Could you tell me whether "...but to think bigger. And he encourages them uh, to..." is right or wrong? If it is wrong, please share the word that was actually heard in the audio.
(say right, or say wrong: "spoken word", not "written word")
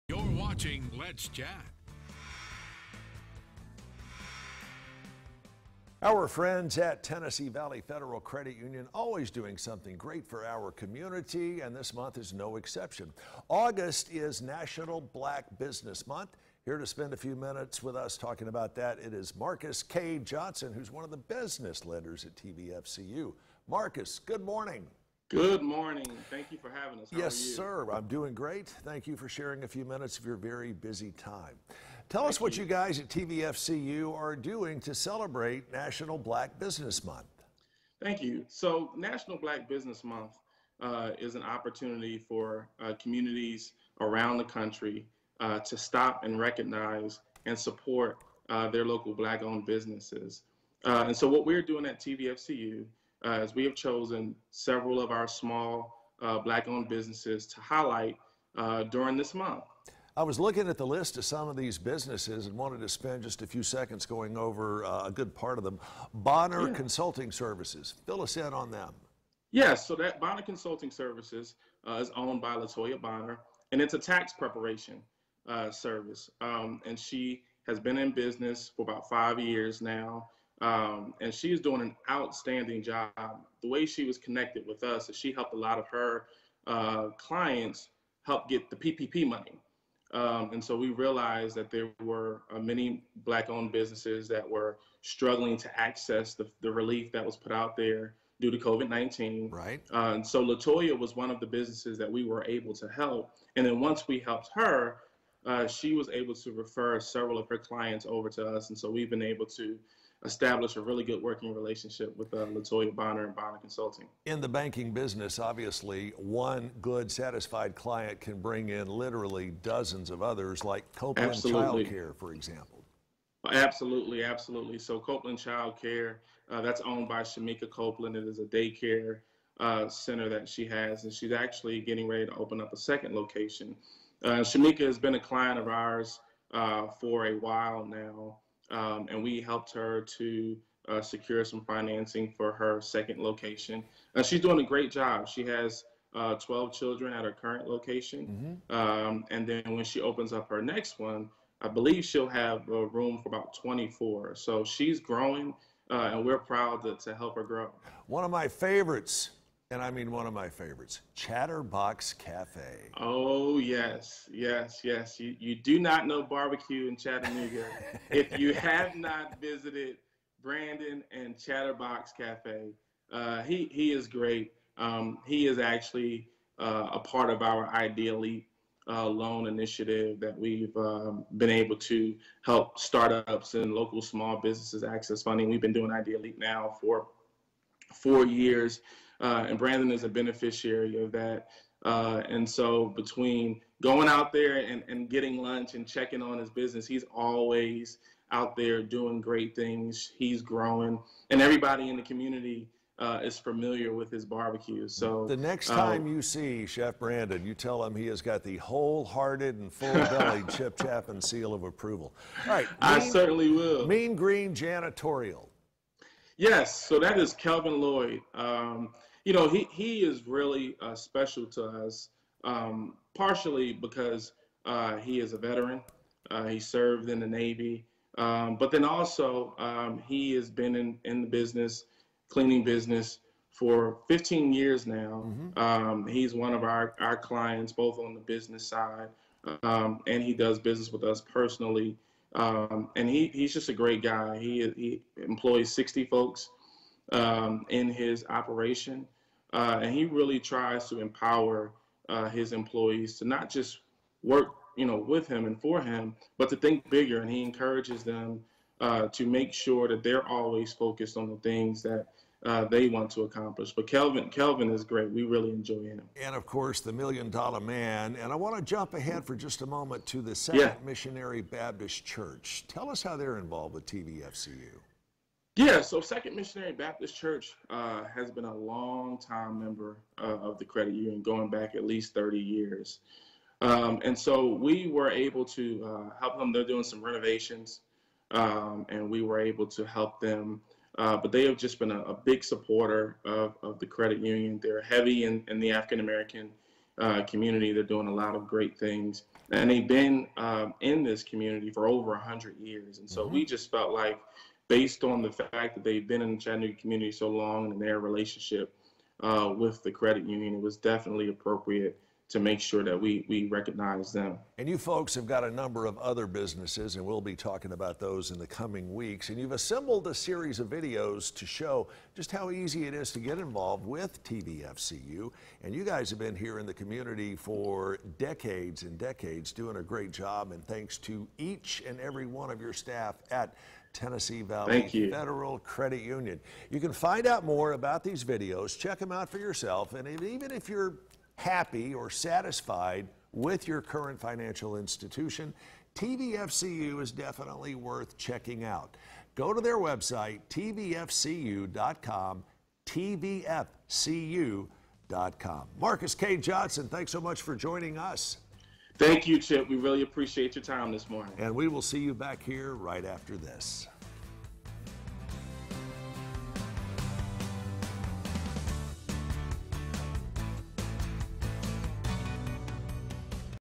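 right.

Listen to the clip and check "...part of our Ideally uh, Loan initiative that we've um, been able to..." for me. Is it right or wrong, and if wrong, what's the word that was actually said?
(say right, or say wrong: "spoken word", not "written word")
right.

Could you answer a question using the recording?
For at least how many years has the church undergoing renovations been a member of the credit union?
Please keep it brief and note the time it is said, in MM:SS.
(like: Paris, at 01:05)
30 years, at 04:42.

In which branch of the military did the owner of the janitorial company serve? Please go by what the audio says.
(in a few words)
Navy.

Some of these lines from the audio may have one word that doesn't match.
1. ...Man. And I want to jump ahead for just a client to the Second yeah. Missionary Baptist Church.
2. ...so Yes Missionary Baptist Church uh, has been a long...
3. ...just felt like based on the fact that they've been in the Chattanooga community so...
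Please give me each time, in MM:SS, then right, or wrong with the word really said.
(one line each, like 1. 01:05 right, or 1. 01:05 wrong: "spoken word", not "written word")
1. 04:27 wrong: "moment", not "client"
2. 04:35 wrong: "Second", not "Yes"
3. 05:03 right.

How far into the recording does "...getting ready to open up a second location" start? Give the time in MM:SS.
02:11.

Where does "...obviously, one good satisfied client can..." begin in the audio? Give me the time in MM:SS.
01:55.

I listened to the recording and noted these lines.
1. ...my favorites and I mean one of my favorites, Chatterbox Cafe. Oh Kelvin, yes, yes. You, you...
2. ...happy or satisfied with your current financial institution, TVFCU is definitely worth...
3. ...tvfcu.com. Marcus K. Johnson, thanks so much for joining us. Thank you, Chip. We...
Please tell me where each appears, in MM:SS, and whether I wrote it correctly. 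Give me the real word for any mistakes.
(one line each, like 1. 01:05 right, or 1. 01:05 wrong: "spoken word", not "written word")
1. 02:38 wrong: "Yes", not "Kelvin"
2. 05:41 right
3. 05:52 right.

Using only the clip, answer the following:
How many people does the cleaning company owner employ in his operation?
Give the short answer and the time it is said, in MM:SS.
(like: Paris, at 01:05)
60, at 04:05.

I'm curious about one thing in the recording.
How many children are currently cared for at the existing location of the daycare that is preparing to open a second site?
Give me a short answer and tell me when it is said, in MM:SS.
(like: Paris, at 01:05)
12, at 02:26.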